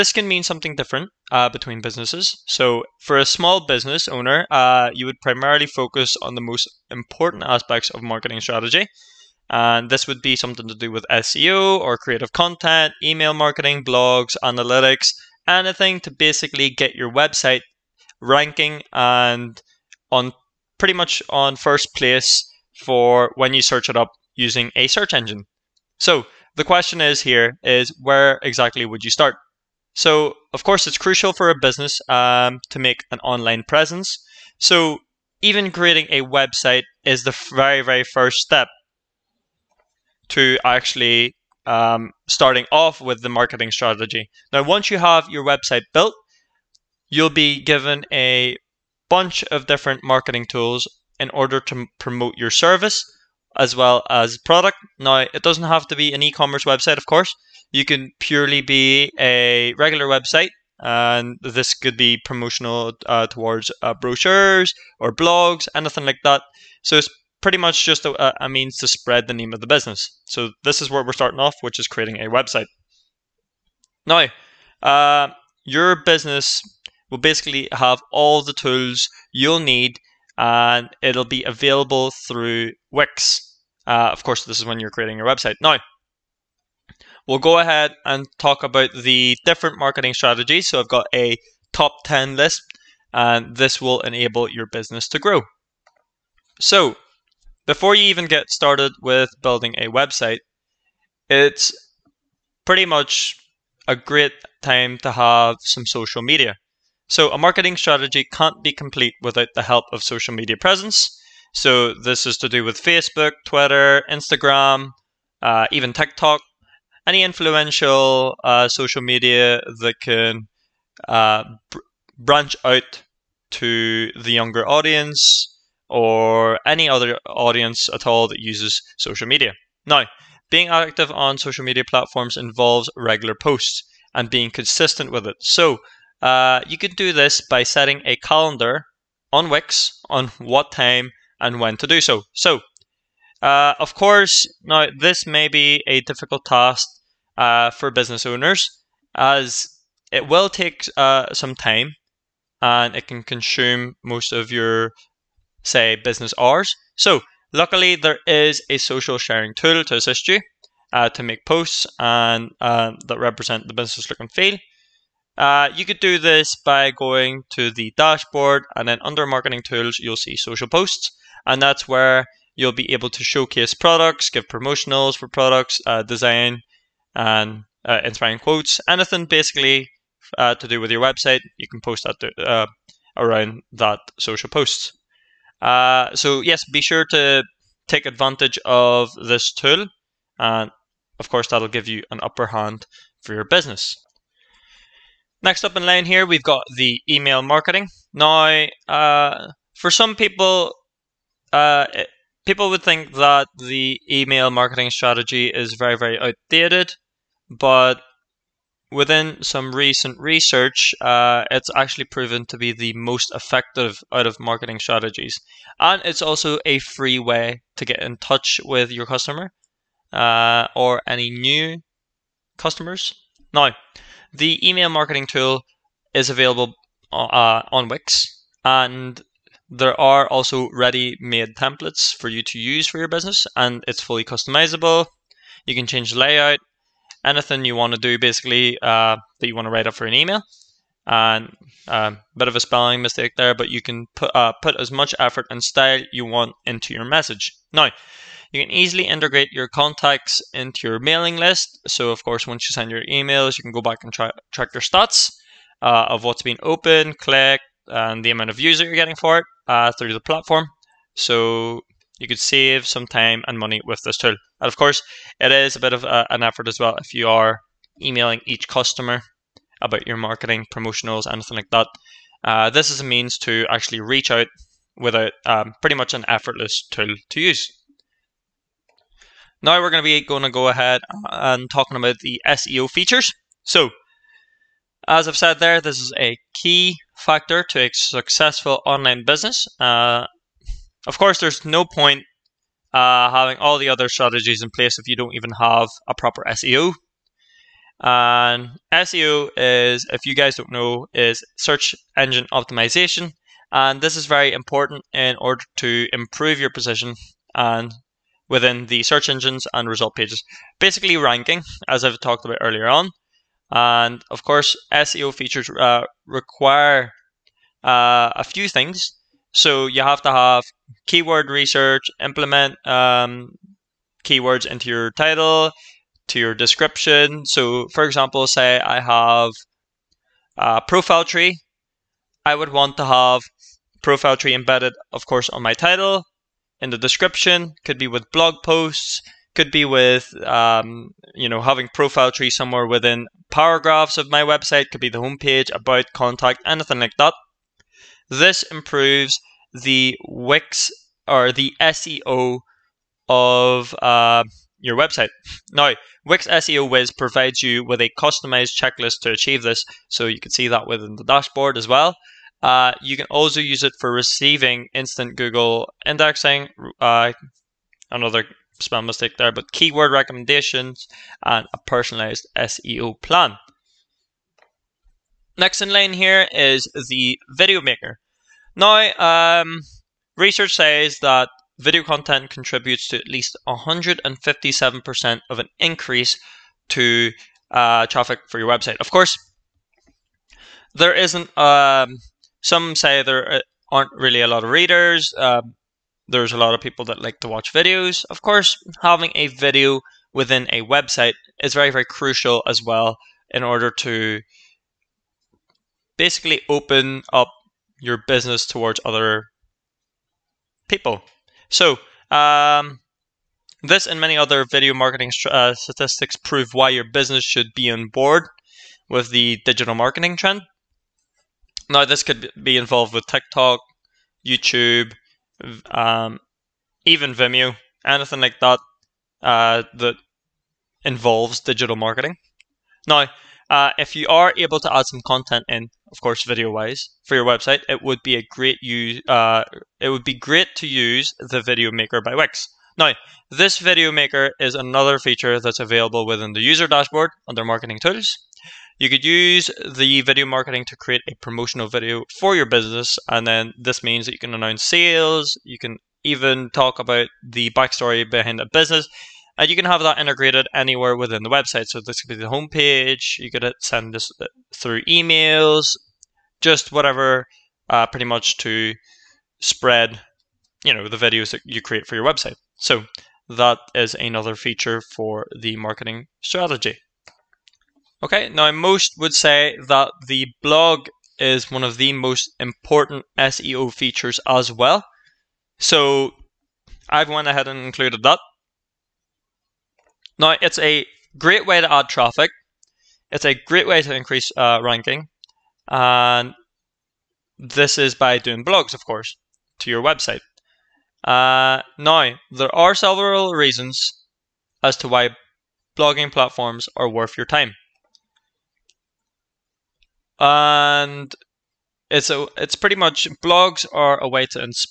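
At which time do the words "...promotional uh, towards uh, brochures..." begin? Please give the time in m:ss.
1:02.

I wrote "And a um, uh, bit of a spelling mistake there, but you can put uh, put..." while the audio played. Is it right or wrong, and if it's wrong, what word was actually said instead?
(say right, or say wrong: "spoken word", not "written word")
right.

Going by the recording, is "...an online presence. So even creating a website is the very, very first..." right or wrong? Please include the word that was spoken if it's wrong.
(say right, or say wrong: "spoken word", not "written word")
right.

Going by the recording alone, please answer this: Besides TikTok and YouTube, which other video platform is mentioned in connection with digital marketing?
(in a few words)
Vimeo.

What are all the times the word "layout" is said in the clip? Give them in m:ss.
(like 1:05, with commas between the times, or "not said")
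3:56.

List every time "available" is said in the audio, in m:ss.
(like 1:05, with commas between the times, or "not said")
1:21, 3:46, 7:25.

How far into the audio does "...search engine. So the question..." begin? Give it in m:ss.
0:24.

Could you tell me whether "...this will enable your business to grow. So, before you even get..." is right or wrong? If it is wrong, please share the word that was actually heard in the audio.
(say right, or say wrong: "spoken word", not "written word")
right.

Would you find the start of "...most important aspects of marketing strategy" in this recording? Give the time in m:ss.
0:06.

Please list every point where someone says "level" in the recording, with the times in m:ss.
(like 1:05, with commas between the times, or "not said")
not said.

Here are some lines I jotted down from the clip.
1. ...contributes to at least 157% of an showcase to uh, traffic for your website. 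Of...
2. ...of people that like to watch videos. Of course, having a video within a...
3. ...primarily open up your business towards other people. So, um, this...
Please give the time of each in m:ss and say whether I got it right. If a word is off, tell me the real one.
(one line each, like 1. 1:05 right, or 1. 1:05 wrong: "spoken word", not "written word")
1. 6:22 wrong: "increase", not "showcase"
2. 6:36 right
3. 6:46 wrong: "basically", not "primarily".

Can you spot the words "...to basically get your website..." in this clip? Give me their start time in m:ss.
0:16.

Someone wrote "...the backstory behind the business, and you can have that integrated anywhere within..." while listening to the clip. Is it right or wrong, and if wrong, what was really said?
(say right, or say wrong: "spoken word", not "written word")
right.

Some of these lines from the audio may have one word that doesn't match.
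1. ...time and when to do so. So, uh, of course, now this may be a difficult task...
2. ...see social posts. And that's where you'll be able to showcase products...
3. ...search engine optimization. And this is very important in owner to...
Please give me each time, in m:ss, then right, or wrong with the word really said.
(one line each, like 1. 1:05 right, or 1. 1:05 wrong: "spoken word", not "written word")
1. 2:20 right
2. 2:50 right
3. 5:01 wrong: "order", not "owner".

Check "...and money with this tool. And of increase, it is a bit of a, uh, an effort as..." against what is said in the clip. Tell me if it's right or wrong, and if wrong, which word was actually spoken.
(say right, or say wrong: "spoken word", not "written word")
wrong: "course", not "increase".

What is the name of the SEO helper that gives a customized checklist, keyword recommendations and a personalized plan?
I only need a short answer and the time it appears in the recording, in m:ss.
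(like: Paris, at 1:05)
Wix SEO Wiz, at 5:56.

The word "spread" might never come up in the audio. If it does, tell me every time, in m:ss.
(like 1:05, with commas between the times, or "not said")
1:08, 7:49.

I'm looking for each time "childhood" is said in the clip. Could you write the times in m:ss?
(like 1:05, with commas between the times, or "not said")
not said.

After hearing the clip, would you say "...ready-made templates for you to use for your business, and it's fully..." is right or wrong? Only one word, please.
right.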